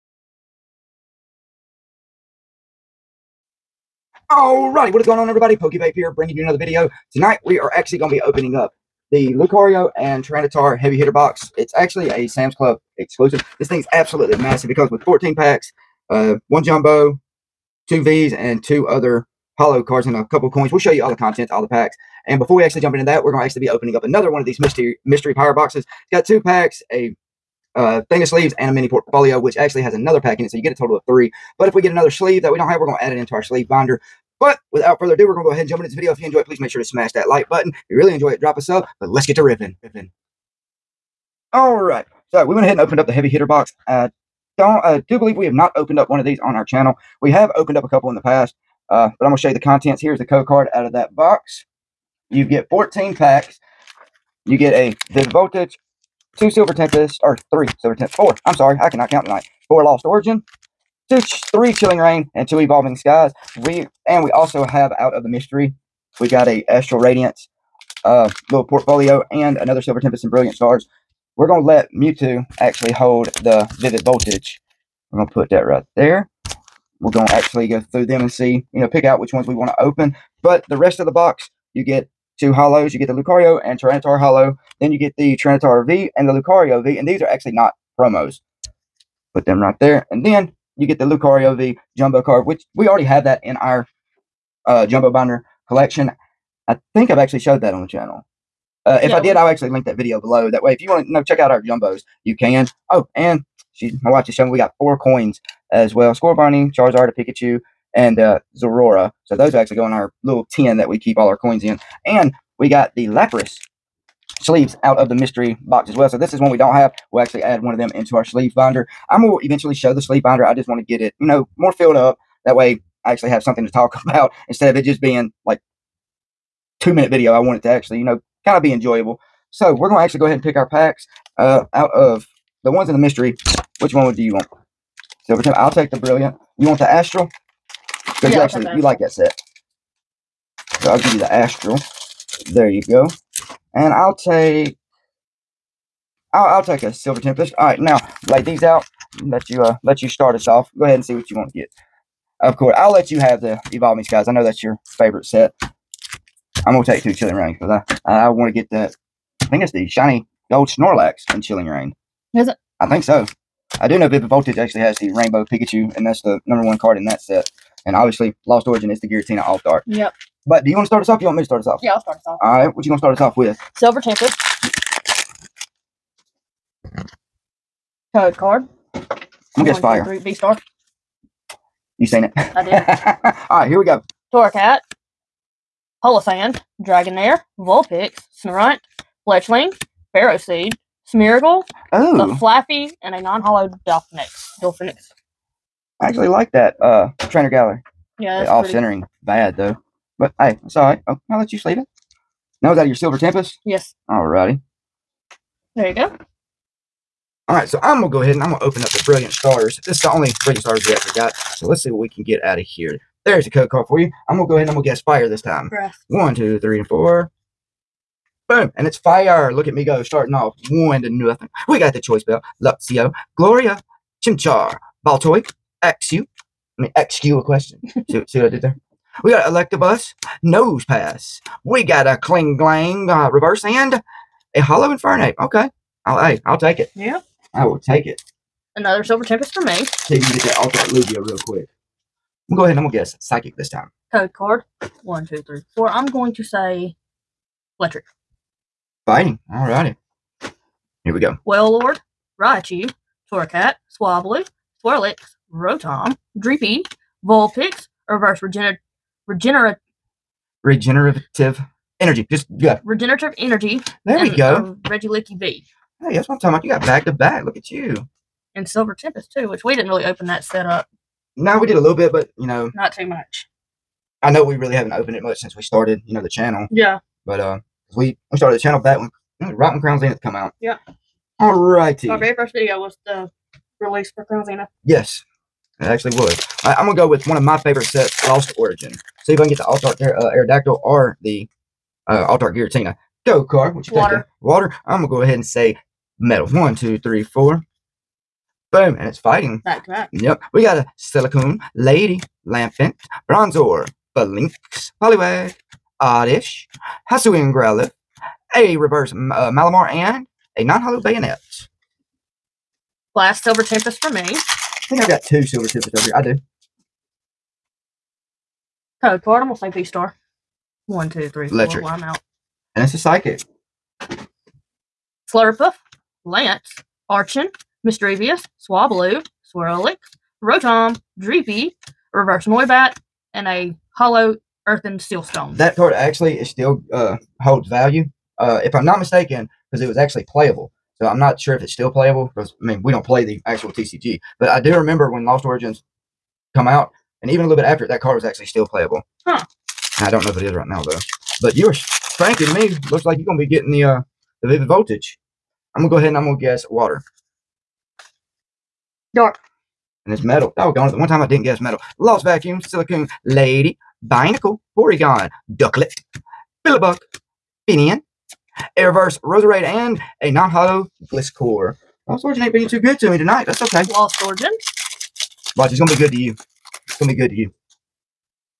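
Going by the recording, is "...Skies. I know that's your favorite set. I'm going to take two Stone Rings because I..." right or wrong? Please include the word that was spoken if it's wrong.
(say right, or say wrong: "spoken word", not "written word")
wrong: "Chilling", not "Stone".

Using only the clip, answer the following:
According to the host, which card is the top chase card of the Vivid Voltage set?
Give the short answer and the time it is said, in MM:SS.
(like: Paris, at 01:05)
Rainbow Pikachu, at 02:45.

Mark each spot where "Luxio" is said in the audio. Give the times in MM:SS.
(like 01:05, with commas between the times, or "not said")
03:42.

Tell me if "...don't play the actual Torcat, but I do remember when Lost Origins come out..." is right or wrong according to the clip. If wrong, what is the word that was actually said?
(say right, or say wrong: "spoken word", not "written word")
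wrong: "TCG", not "Torcat".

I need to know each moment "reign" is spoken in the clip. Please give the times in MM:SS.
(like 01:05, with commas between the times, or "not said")
01:01, 02:41.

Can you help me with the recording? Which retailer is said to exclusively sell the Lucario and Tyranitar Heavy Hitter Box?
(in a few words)
Sam's Club.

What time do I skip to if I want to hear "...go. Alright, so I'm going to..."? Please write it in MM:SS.
03:25.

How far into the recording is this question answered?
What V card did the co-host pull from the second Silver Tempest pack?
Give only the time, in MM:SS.
04:24.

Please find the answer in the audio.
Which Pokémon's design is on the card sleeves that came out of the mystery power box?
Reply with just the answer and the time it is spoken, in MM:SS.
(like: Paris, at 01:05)
Lapras, at 01:53.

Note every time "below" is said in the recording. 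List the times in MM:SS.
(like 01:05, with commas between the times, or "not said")
01:40.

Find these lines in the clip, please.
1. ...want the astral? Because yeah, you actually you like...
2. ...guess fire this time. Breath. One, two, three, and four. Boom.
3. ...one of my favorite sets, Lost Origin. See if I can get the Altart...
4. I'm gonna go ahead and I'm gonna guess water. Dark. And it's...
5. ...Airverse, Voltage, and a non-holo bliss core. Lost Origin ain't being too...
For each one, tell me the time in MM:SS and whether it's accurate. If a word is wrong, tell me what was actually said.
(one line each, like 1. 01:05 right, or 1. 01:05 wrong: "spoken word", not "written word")
1. 02:16 right
2. 03:34 right
3. 04:47 right
4. 05:55 right
5. 06:08 wrong: "Roserade", not "Voltage".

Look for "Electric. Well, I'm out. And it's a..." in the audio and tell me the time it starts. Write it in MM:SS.
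05:21.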